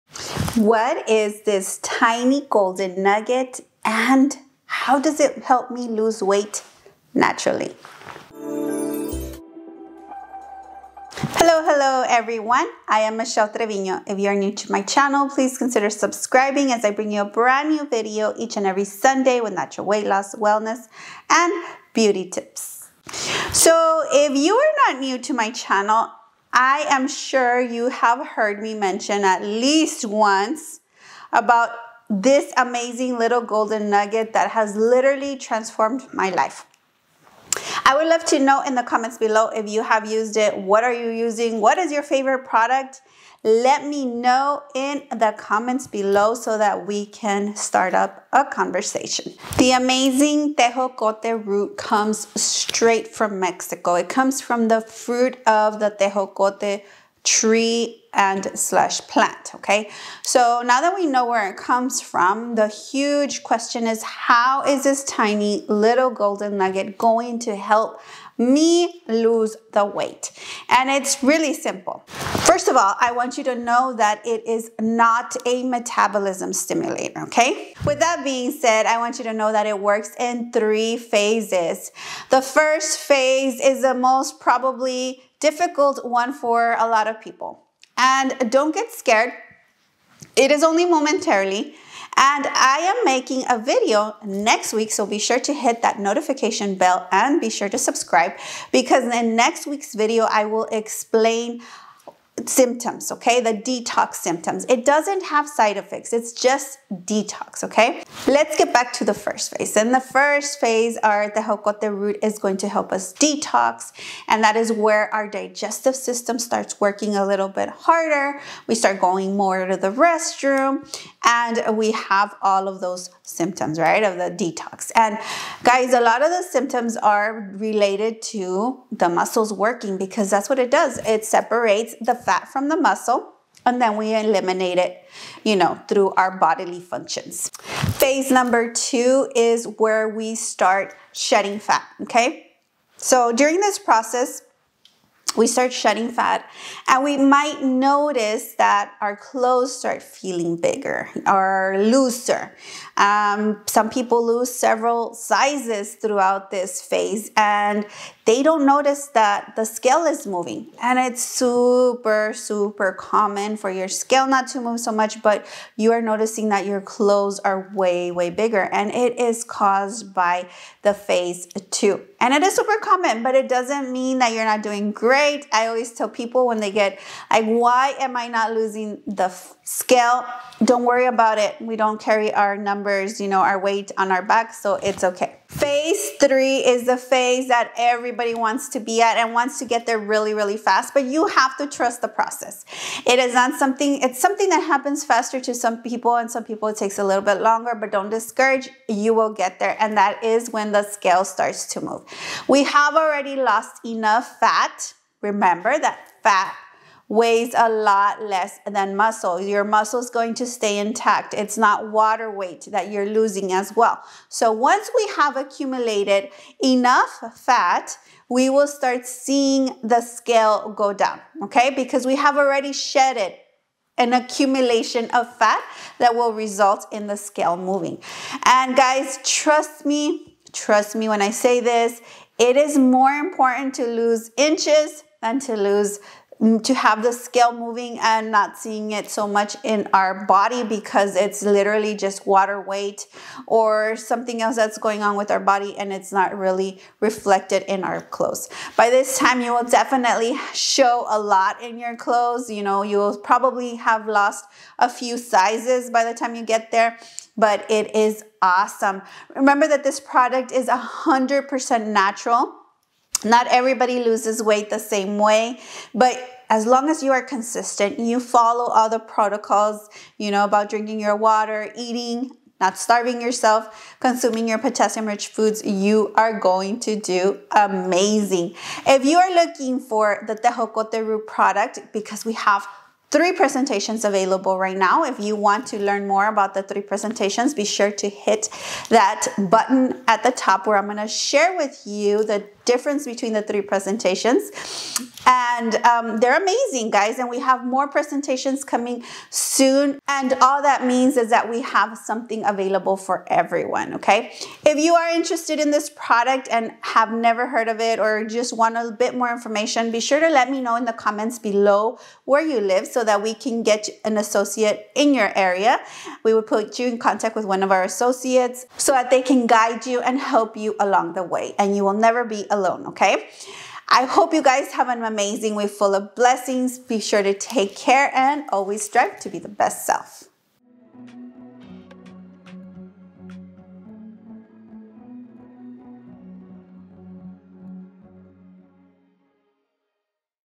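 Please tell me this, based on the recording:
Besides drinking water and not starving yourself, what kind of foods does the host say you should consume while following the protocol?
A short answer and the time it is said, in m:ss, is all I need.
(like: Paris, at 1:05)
Potassium rich foods, at 4:34.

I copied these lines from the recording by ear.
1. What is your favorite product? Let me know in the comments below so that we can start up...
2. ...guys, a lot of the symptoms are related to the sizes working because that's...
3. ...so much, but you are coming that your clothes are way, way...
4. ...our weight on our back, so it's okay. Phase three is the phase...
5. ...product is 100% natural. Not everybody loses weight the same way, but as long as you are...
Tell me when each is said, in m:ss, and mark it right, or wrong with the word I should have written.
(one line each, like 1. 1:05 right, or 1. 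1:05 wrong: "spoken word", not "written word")
1. 0:41 right
2. 2:05 wrong: "muscles", not "sizes"
3. 2:44 wrong: "noticing", not "coming"
4. 3:03 right
5. 4:19 right.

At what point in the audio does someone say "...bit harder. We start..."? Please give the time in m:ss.
1:57.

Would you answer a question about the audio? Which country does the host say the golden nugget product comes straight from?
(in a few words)
Mexico.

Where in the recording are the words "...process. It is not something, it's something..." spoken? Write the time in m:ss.
3:12.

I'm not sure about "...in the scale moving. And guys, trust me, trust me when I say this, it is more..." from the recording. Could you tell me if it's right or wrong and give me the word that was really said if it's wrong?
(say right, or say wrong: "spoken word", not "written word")
right.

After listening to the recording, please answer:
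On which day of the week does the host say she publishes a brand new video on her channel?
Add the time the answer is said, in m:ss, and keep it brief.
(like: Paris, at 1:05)
Sunday, at 0:18.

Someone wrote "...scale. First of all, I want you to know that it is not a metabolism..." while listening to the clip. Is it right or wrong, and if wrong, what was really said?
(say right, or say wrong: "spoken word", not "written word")
wrong: "simple", not "scale".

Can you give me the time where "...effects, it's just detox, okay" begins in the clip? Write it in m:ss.
1:45.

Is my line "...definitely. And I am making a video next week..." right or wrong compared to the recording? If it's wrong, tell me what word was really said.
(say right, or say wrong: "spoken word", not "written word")
wrong: "momentarily", not "definitely".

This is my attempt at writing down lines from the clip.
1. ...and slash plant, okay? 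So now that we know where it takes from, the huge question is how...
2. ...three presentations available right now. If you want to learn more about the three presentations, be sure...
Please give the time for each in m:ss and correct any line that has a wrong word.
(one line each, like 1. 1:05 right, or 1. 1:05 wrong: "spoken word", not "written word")
1. 0:58 wrong: "comes", not "takes"
2. 4:43 right.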